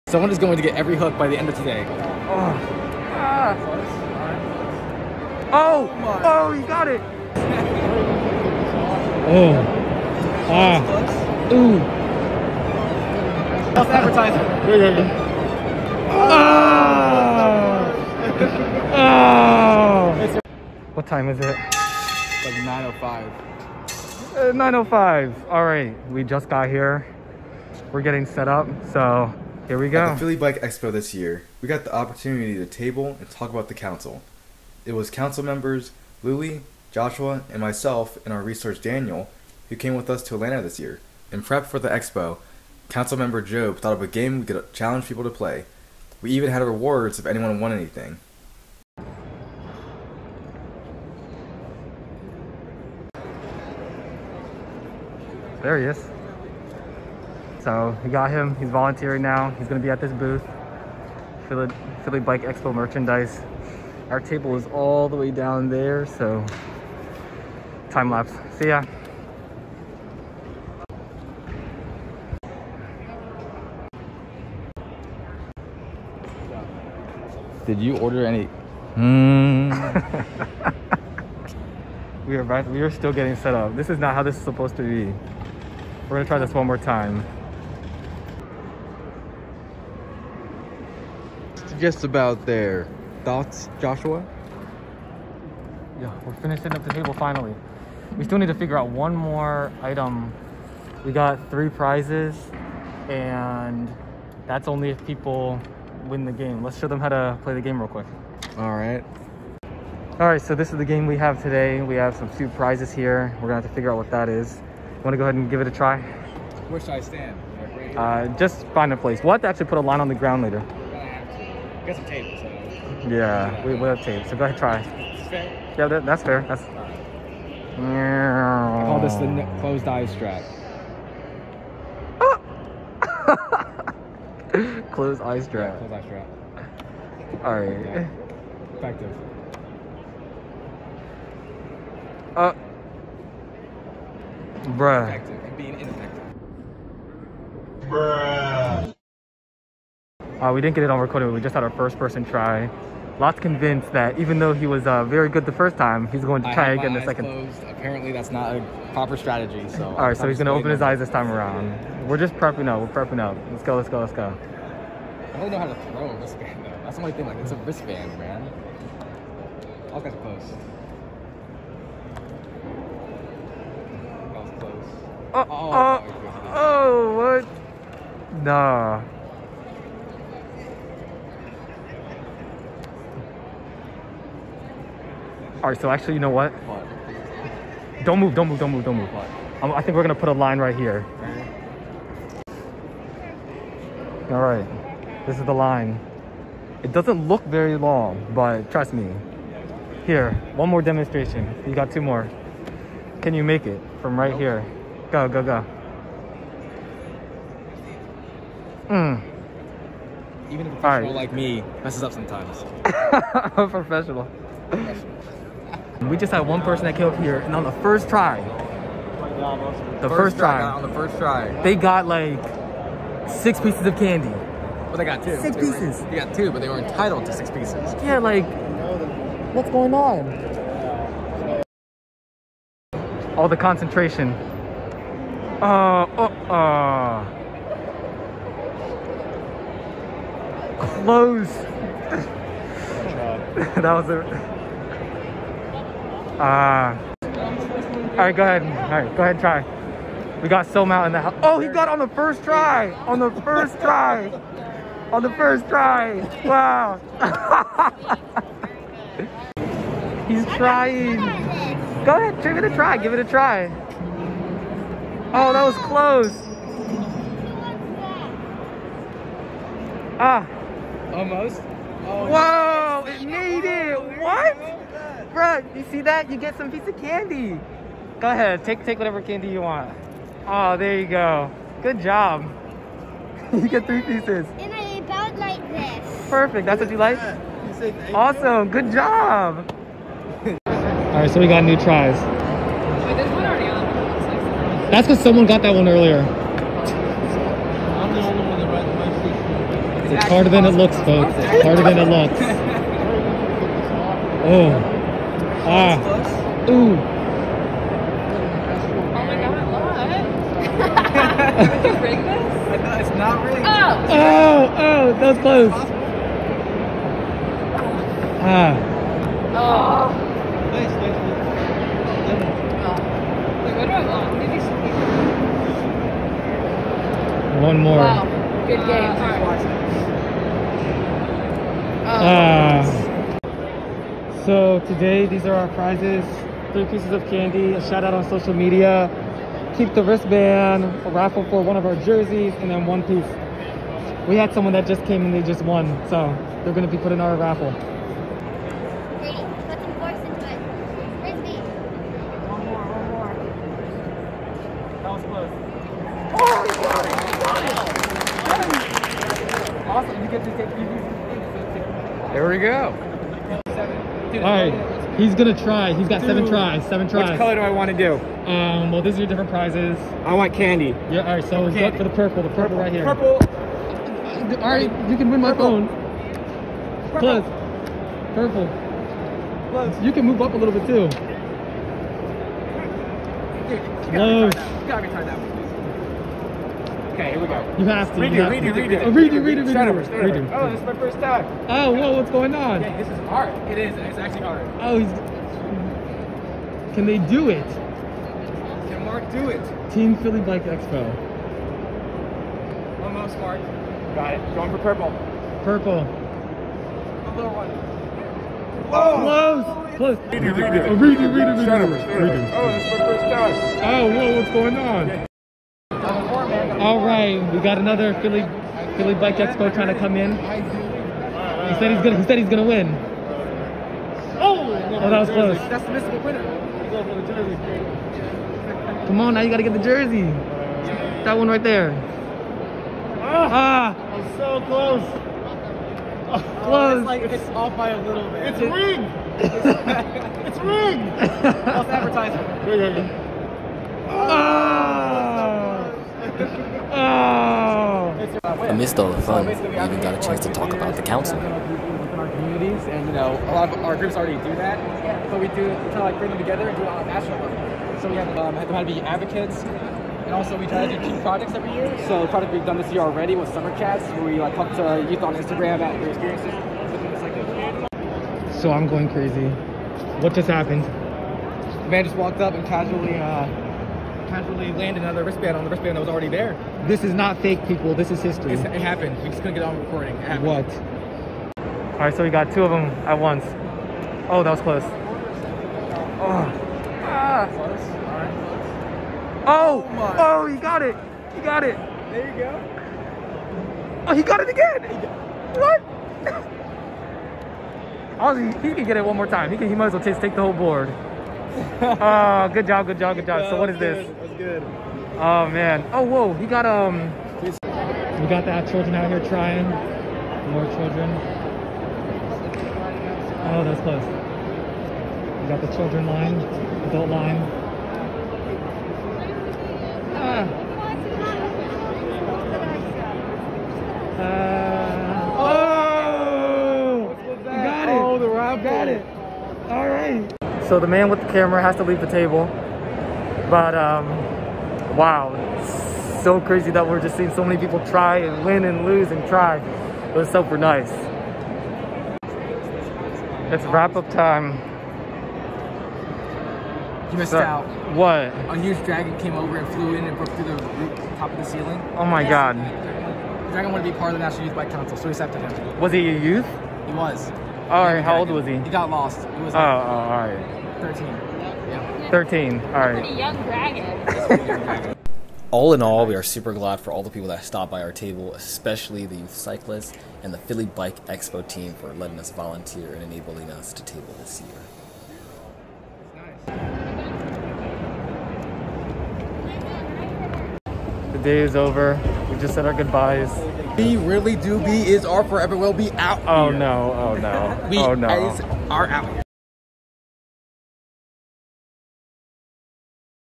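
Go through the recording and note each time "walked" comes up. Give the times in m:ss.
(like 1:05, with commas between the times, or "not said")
7:52.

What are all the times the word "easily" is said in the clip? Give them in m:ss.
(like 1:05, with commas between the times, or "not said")
not said.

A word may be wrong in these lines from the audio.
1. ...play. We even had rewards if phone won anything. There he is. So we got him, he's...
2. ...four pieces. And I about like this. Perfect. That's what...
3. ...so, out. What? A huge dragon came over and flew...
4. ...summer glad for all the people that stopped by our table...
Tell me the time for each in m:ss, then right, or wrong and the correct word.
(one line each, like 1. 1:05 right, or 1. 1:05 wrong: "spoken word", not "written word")
1. 0:45 wrong: "anyone", not "phone"
2. 4:43 wrong: "three", not "four"
3. 9:07 right
4. 9:26 wrong: "super", not "summer".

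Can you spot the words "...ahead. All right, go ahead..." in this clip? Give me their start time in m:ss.
4:08.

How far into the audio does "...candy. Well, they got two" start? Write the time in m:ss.
3:43.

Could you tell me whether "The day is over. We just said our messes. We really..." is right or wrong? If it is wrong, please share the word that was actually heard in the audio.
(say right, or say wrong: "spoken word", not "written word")
wrong: "goodbyes", not "messes".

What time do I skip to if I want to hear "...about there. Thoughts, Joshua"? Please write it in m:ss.
1:32.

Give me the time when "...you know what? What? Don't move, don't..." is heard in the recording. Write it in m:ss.
3:06.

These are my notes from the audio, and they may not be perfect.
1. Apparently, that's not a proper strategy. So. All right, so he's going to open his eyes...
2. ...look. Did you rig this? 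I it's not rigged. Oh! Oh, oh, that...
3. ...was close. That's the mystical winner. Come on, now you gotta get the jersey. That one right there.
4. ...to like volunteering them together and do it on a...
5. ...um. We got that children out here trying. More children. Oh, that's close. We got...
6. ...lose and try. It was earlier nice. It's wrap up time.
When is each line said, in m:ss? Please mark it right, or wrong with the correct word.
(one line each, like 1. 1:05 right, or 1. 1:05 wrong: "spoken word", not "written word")
1. 2:37 right
2. 5:09 right
3. 7:05 right
4. 7:35 wrong: "bring", not "volunteering"
5. 8:26 right
6. 8:58 wrong: "super", not "earlier".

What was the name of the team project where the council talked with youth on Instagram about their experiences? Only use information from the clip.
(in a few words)
summer chats.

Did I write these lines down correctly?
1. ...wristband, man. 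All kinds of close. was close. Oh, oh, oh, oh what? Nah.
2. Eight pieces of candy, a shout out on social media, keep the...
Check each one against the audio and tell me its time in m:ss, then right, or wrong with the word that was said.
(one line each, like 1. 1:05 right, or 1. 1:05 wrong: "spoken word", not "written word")
1. 2:47 right
2. 5:36 wrong: "Three", not "Eight".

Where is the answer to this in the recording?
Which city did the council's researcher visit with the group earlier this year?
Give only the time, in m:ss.
0:40.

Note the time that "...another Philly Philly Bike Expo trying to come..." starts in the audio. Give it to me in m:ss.
6:57.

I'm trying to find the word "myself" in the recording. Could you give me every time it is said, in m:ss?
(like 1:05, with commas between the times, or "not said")
0:37.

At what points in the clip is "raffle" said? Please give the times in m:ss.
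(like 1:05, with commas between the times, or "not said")
5:41, 5:47.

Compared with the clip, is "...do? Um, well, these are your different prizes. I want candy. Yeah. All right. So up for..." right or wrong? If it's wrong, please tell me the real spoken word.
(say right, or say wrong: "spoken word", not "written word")
right.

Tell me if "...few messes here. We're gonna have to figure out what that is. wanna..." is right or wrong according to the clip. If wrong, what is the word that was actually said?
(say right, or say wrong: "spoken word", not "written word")
wrong: "prizes", not "messes".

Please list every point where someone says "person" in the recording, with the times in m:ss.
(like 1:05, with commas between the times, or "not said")
2:31, 3:36.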